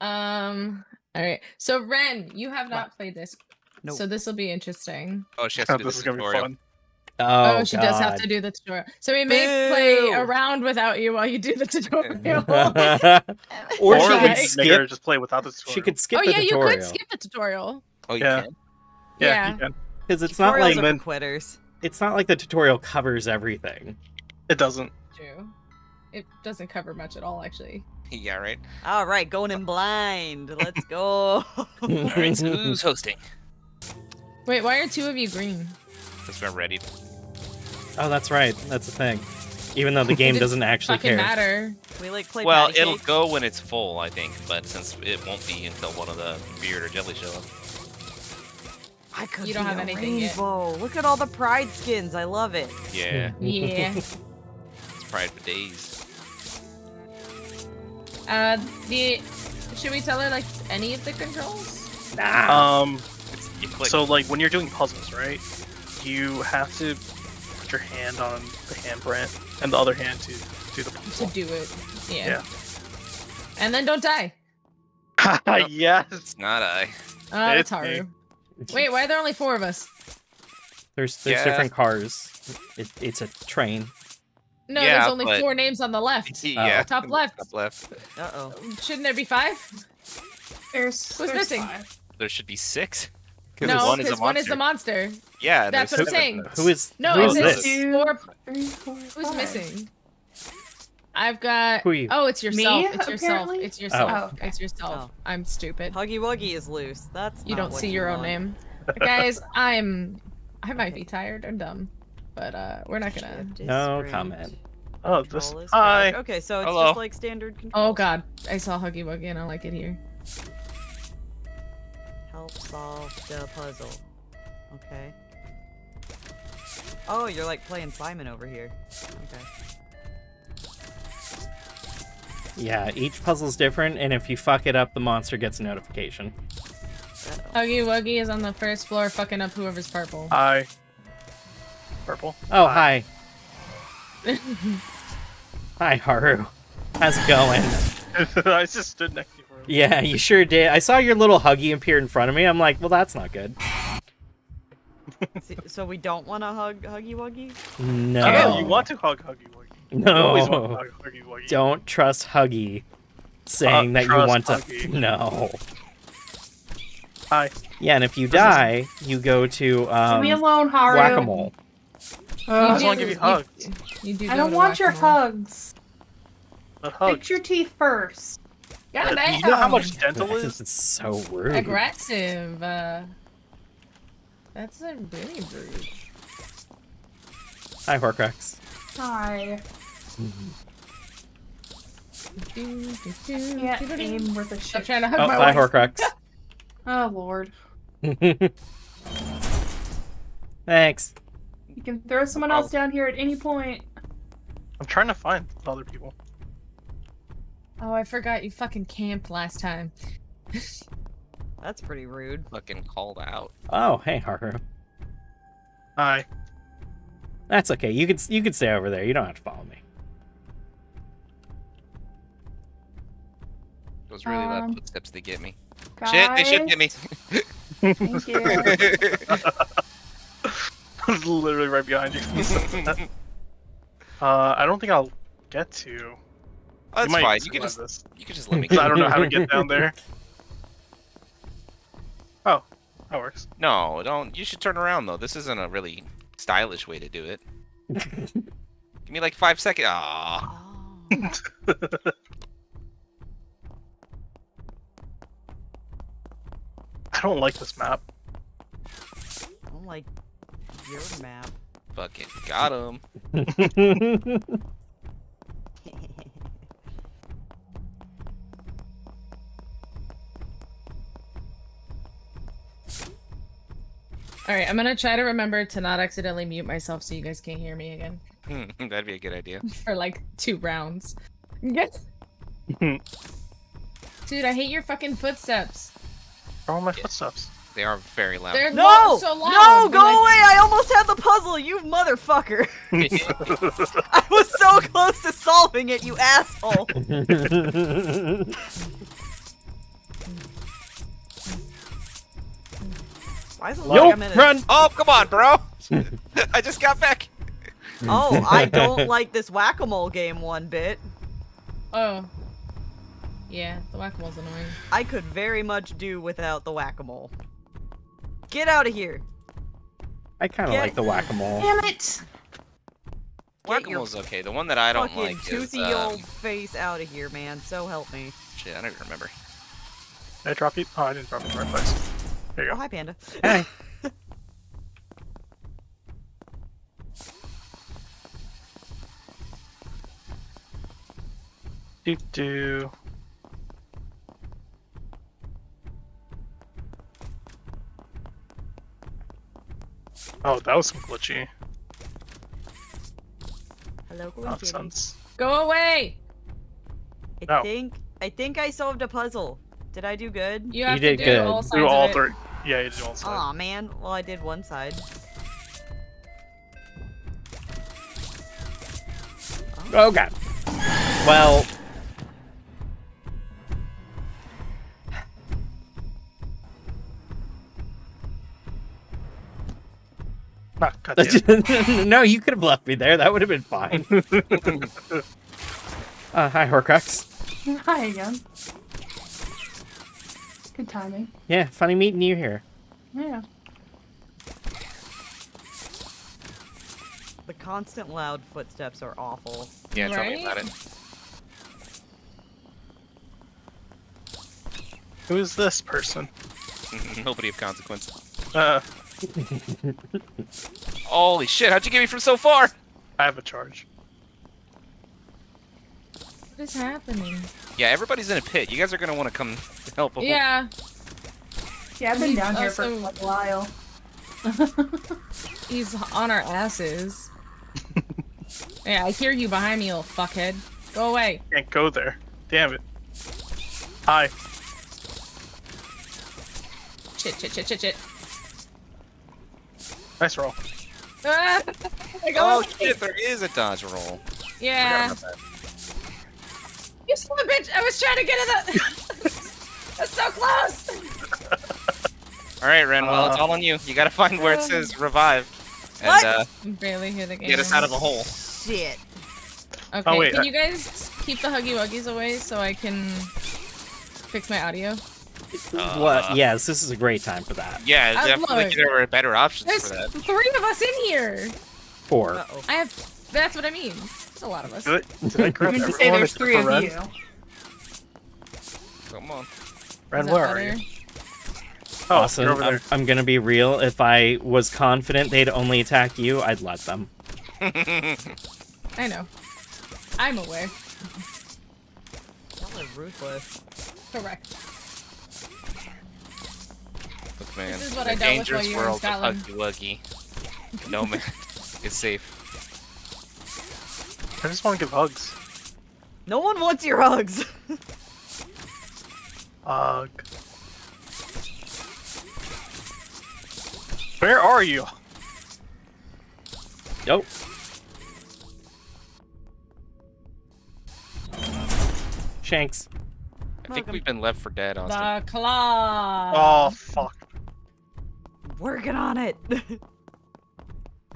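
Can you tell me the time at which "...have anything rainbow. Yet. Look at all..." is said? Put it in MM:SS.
00:49.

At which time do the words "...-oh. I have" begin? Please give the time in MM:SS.
07:52.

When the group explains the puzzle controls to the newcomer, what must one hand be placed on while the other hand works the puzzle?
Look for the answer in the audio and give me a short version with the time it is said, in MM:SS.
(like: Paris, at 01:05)
the handprint, at 01:08.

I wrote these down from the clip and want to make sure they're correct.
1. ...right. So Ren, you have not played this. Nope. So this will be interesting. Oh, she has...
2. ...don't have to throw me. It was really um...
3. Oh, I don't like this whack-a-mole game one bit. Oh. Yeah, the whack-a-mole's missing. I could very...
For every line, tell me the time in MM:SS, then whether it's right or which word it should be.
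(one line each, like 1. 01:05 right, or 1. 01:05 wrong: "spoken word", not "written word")
1. 00:01 right
2. 03:39 wrong: "follow", not "throw"
3. 05:08 wrong: "annoying", not "missing".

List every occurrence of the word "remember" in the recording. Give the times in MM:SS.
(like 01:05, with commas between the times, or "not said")
04:35, 05:29.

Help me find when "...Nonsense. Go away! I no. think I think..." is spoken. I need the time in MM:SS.
05:54.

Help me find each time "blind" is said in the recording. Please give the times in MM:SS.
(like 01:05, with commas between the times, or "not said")
00:29.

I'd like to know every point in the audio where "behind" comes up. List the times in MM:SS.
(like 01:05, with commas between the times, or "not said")
03:51, 07:09.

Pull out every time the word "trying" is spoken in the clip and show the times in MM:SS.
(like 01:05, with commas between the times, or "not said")
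03:14, 03:24, 07:27.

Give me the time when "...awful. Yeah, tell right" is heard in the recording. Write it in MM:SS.
06:39.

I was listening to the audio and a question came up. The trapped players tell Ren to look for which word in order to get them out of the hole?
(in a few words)
revive.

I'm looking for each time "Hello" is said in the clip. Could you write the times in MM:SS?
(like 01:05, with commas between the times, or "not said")
01:56, 05:54.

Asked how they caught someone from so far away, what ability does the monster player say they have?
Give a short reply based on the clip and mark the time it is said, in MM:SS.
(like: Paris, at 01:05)
a charge, at 06:53.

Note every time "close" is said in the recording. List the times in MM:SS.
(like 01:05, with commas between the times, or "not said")
04:54, 07:30.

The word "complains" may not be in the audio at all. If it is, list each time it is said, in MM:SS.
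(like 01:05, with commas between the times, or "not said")
not said.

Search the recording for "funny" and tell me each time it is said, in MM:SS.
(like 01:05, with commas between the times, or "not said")
06:31.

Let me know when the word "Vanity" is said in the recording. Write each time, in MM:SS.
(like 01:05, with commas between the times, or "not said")
not said.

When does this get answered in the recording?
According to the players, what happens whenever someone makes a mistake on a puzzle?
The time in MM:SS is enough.
02:14.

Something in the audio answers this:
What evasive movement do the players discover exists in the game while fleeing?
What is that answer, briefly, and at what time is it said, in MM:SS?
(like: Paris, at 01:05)
a dodge roll, at 07:22.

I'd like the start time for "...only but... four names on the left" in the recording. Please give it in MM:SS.
01:25.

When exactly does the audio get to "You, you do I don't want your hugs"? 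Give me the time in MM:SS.
02:54.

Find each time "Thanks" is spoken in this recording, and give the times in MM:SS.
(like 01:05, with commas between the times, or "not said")
03:20, 03:46.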